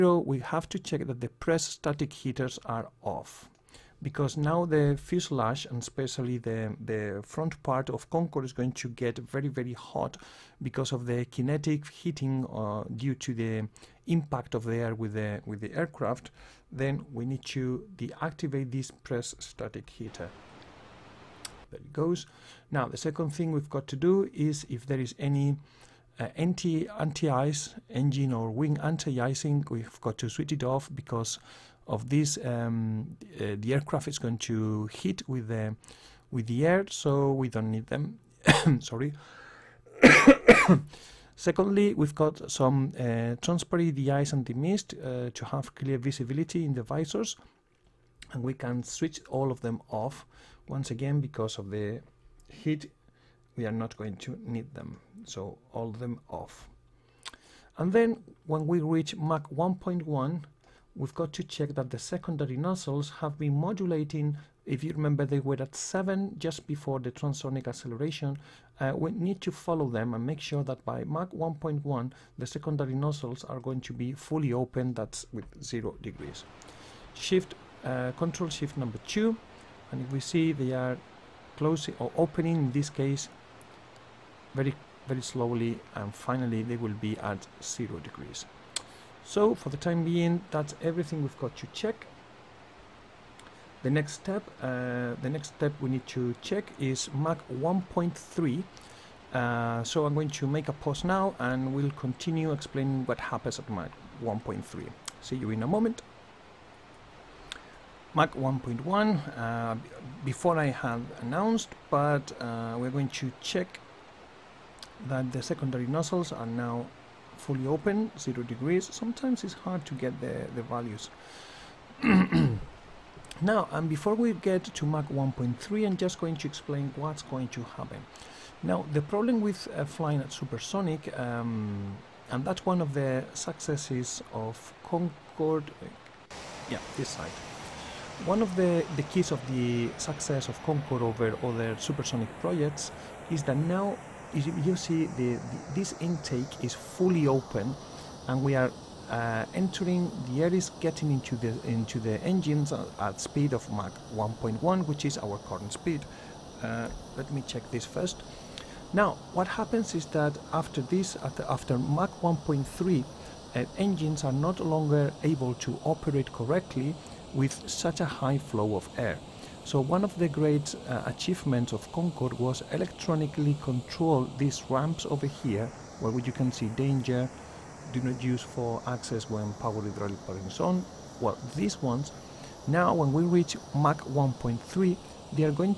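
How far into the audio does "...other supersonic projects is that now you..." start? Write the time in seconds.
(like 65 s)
141 s.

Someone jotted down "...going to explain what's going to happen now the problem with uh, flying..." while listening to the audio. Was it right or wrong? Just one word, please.
right.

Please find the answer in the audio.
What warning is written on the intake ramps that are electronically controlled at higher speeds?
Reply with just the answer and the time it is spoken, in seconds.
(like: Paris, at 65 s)
Danger, do not use for access, at 176 s.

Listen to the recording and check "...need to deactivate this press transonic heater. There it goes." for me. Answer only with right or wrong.
wrong.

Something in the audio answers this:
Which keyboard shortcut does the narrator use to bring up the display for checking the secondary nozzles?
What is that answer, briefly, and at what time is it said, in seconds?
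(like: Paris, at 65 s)
Control Shift 2, at 78 s.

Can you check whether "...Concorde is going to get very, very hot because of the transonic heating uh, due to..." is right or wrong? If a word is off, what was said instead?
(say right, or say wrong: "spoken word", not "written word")
wrong: "kinetic", not "transonic".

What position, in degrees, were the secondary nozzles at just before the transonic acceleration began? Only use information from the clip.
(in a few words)
7.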